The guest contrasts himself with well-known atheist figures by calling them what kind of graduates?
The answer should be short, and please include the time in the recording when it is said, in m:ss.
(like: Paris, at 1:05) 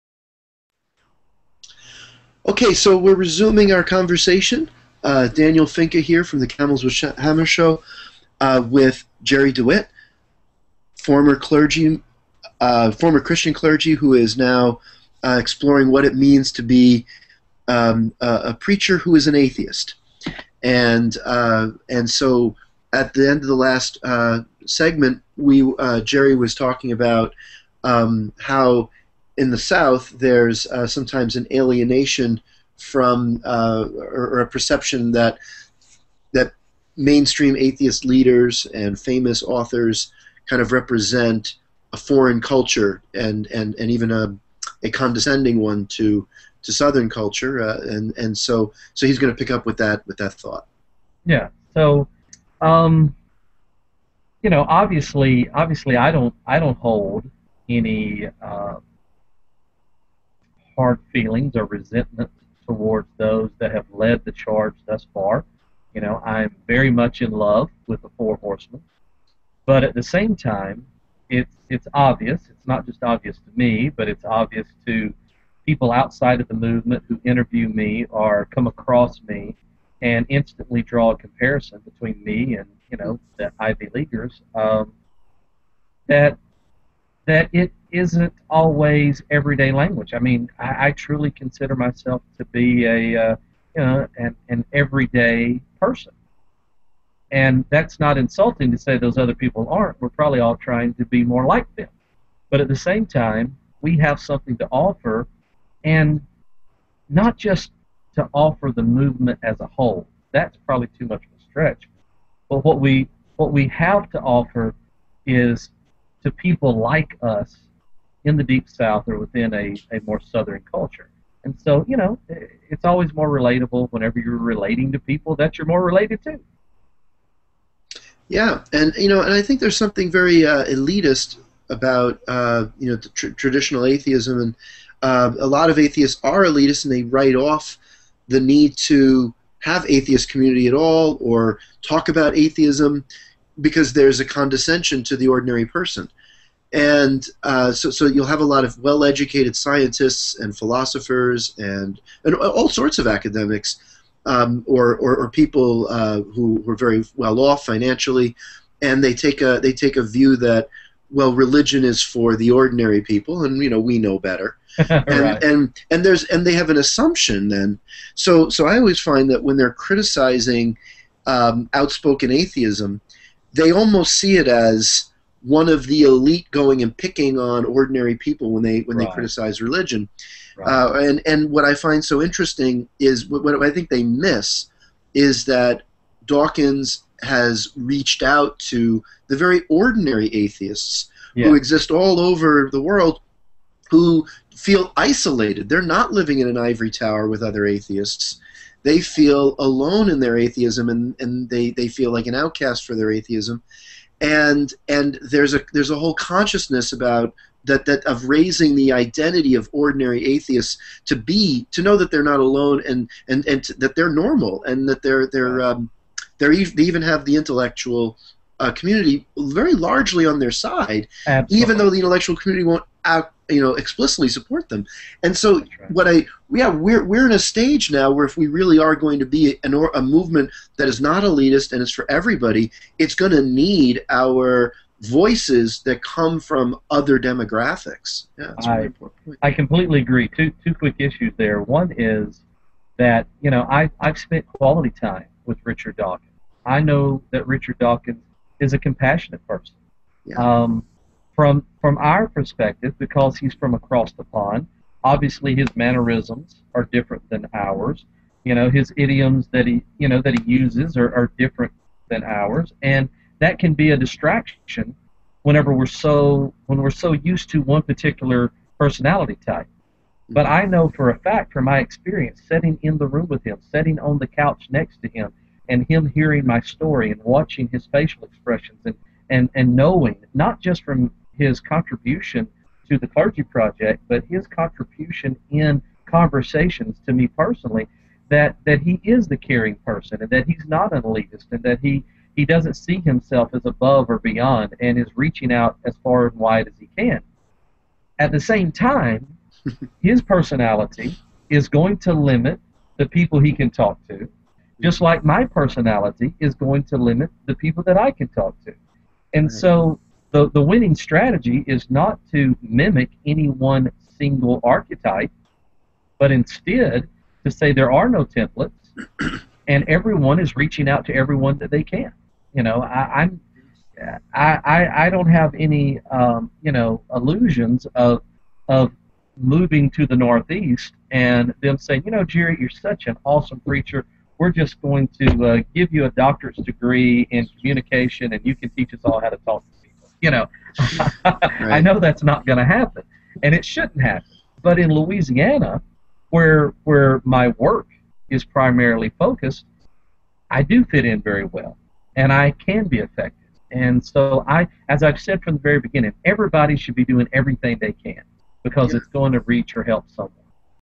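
Ivy Leaguers, at 1:23.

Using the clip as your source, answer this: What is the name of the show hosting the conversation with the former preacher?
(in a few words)
Camels with Hammers Show.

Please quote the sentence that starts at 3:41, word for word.
even though the intellectual community won't out you know explicitly support them.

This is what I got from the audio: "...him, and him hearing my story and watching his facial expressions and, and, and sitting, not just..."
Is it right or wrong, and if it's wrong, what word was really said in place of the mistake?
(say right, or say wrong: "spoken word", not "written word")
wrong: "knowing", not "sitting".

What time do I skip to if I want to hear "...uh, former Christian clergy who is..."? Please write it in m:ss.
0:12.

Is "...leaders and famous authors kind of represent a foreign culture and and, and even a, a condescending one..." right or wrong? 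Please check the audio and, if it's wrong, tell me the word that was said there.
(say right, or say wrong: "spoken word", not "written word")
right.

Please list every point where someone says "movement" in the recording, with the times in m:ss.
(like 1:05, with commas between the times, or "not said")
1:16, 1:48, 3:50.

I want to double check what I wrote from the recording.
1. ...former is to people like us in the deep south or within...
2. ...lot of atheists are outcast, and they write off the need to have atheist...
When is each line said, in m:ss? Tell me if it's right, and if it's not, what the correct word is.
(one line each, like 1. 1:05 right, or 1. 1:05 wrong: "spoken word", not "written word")
1. 1:54 wrong: "offer", not "former"
2. 2:15 wrong: "elitist", not "outcast".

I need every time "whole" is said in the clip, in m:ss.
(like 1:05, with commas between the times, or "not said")
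1:49, 3:25.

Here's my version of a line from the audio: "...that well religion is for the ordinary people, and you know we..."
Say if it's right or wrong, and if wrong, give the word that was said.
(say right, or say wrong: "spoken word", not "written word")
right.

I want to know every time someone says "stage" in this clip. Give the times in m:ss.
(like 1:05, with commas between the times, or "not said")
3:47.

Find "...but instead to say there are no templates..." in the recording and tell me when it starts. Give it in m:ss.
5:16.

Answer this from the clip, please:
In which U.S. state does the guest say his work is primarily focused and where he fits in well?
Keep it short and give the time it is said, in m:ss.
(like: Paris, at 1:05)
Louisiana, at 5:44.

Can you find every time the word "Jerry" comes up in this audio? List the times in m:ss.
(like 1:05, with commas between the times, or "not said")
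0:09, 0:26, 5:32.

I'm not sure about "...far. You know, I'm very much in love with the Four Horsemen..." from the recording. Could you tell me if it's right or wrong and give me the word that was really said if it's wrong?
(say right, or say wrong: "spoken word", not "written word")
right.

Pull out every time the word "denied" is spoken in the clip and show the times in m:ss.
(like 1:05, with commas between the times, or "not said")
not said.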